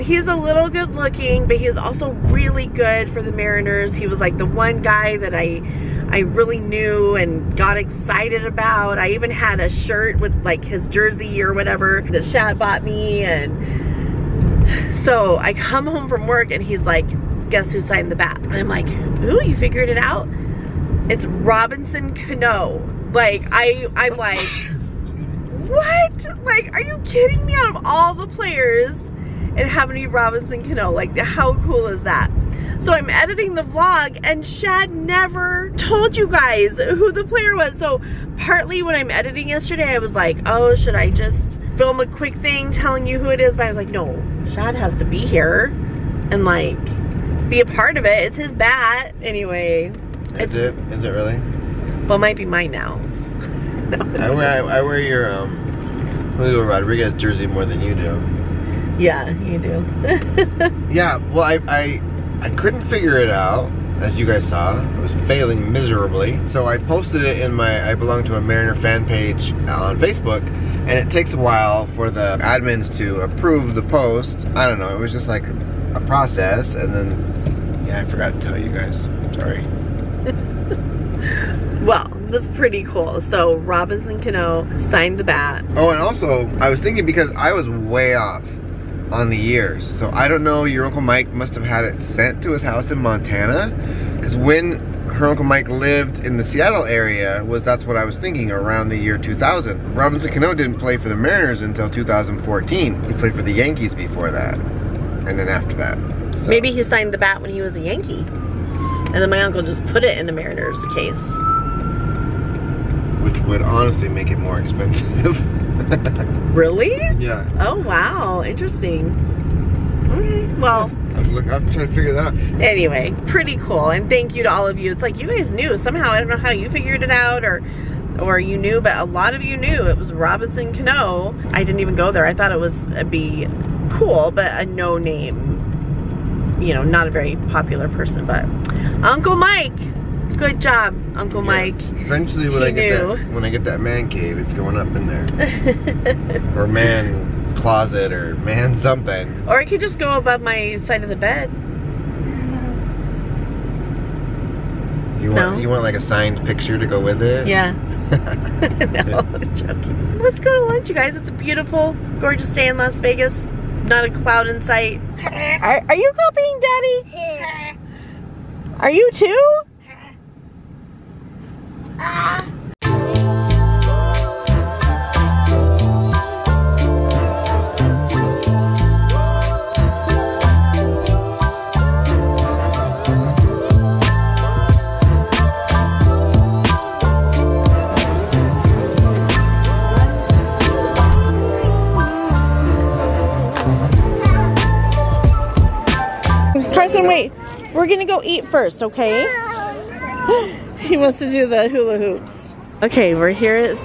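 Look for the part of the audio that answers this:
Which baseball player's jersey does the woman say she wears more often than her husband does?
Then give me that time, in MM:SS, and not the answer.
00:56.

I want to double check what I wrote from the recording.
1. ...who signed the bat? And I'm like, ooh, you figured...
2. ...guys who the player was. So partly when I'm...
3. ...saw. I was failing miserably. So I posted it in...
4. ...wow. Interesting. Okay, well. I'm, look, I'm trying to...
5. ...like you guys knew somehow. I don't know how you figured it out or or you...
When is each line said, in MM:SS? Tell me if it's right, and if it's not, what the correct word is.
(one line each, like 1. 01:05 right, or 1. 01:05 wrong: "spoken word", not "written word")
1. 00:17 right
2. 00:36 right
3. 01:04 right
4. 01:57 right
5. 02:05 right.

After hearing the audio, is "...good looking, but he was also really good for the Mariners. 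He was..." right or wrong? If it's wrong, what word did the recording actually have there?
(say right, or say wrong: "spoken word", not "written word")
right.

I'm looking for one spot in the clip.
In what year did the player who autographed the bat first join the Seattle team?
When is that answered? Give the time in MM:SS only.
01:41.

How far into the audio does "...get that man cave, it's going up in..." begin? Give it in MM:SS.
02:23.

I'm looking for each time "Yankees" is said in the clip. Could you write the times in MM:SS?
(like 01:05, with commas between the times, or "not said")
01:43, 01:47.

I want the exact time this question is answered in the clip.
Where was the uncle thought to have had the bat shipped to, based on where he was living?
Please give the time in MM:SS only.
01:32.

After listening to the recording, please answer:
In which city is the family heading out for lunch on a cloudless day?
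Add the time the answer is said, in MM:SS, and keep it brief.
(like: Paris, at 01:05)
Las Vegas, at 02:42.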